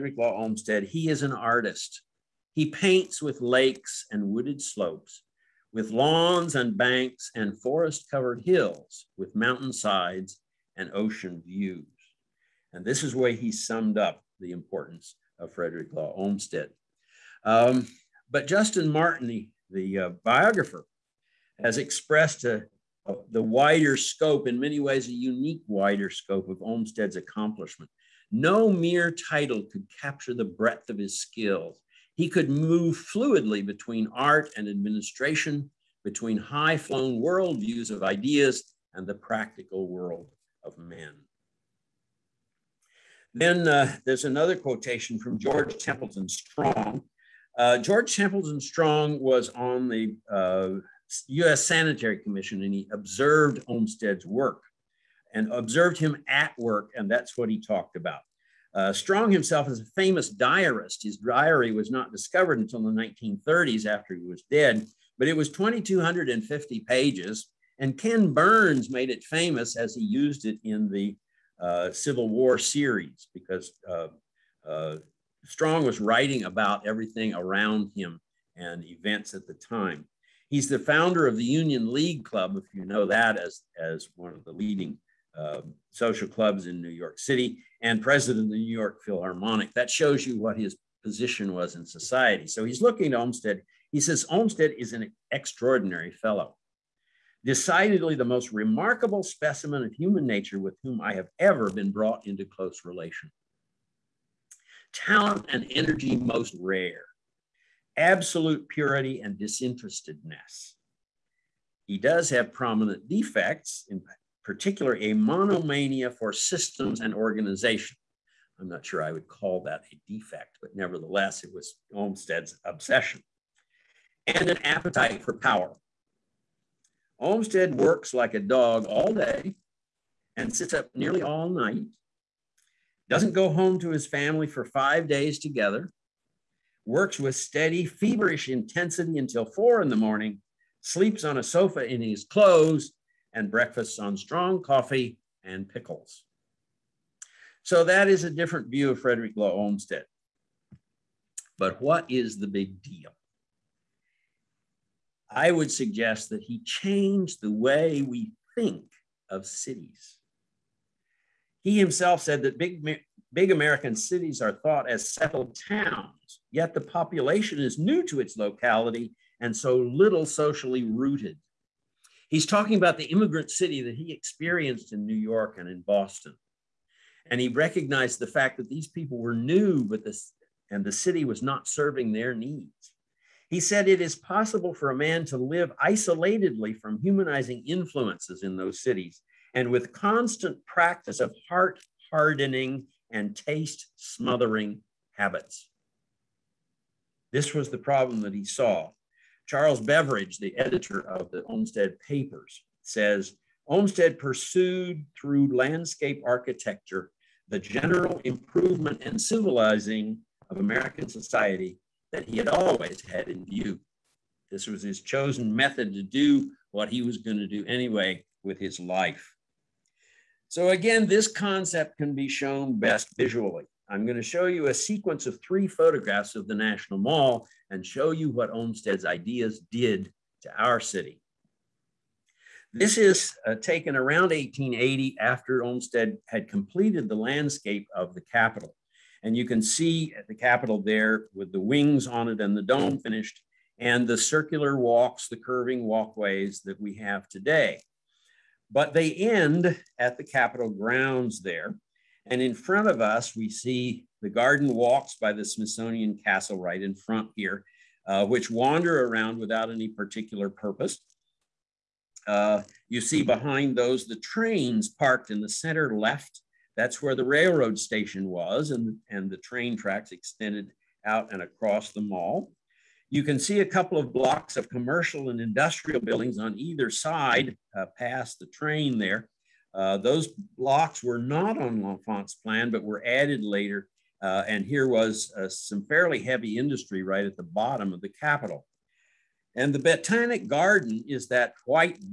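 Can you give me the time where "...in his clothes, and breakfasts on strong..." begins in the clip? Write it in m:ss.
2:21.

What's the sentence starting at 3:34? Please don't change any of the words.
This was his chosen method to do what he was going to do anyway with his life.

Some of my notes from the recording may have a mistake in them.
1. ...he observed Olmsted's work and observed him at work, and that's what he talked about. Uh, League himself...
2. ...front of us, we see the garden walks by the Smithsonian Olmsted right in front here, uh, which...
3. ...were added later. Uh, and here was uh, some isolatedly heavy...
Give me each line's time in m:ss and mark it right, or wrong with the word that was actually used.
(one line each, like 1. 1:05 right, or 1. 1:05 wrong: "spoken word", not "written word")
1. 0:52 wrong: "Strong", not "League"
2. 4:12 wrong: "Castle", not "Olmsted"
3. 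4:42 wrong: "fairly", not "isolatedly".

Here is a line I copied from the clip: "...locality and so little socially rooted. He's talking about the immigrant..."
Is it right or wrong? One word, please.
right.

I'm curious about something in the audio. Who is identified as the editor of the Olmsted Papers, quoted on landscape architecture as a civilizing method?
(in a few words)
Charles Beveridge.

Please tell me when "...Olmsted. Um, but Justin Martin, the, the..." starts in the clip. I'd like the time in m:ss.
0:16.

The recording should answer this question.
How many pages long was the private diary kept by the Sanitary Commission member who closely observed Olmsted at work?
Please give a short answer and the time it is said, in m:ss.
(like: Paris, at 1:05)
2,250, at 1:05.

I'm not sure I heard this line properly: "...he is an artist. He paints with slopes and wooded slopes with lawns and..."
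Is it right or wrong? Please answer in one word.
wrong.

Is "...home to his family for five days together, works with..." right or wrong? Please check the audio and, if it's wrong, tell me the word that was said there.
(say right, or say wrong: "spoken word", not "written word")
right.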